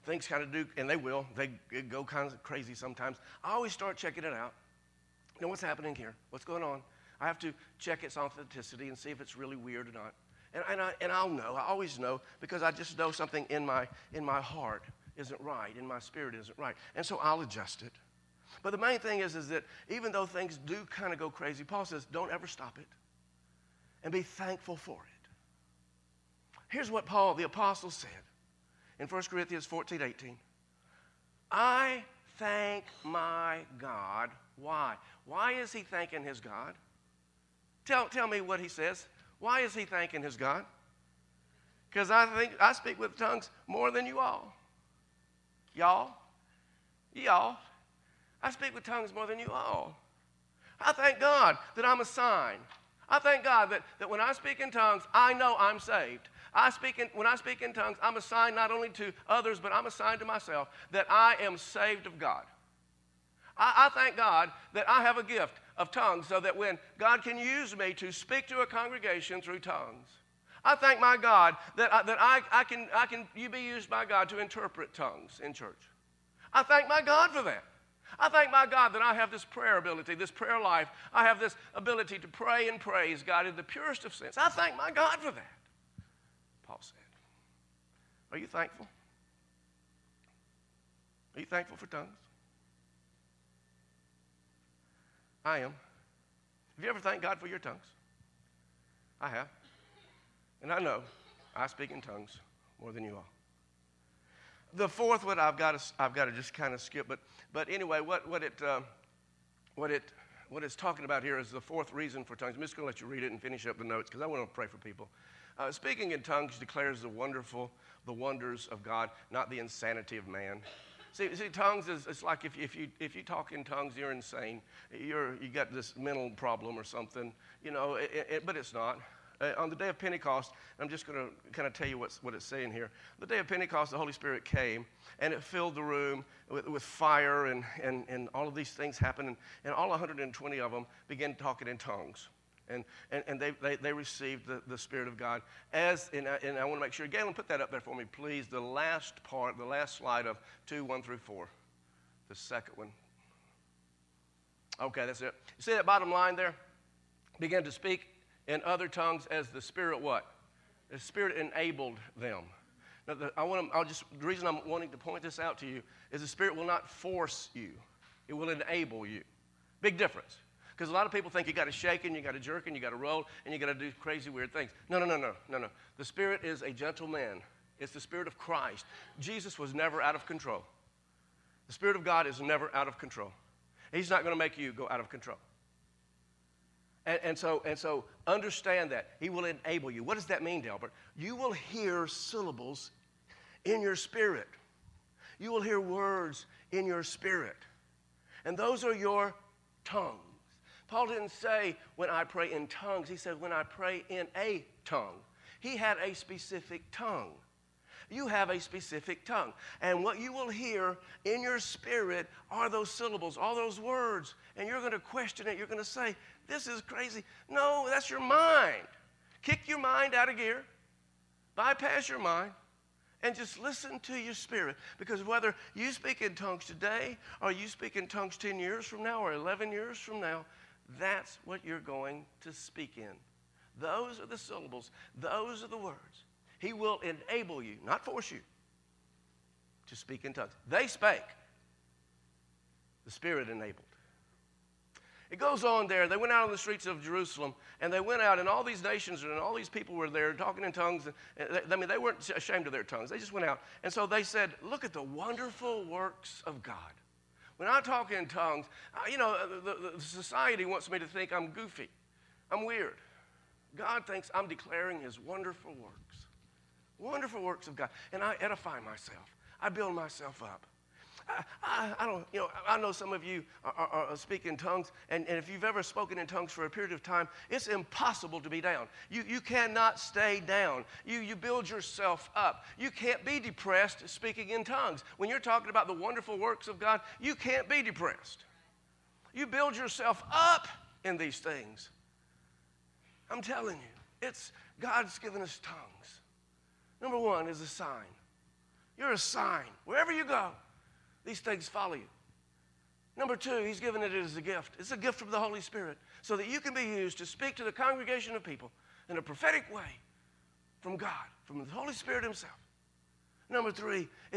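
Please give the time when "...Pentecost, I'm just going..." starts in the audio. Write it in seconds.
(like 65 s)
129 s.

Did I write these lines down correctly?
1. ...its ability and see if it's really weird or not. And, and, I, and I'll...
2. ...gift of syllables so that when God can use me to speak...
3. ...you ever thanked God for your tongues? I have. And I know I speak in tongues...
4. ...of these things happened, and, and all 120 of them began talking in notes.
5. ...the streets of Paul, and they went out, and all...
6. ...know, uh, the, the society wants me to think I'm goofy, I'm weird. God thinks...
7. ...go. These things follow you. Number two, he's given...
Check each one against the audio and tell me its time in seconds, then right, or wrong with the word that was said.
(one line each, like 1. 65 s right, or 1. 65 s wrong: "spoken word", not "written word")
1. 8 s wrong: "authenticity", not "ability"
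2. 65 s wrong: "tongues", not "syllables"
3. 96 s right
4. 138 s wrong: "tongues", not "notes"
5. 246 s wrong: "Jerusalem", not "Paul"
6. 259 s right
7. 300 s right.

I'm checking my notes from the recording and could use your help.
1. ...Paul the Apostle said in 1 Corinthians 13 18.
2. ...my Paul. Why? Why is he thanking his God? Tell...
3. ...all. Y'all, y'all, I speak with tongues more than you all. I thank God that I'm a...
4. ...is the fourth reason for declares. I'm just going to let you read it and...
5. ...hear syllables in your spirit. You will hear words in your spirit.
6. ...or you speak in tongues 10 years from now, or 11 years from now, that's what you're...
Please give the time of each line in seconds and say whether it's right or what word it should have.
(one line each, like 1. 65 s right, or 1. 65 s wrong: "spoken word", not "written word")
1. 27 s wrong: "14", not "13"
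2. 33 s wrong: "God", not "Paul"
3. 44 s right
4. 111 s wrong: "tongues", not "declares"
5. 191 s right
6. 227 s right.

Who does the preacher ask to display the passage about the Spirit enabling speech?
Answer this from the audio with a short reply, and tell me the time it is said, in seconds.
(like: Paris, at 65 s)
Galen, at 147 s.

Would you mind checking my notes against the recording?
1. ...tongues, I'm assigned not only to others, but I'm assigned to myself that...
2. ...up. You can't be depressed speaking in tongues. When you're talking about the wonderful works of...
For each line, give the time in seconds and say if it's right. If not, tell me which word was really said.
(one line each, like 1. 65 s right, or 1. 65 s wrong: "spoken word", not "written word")
1. 57 s right
2. 282 s right.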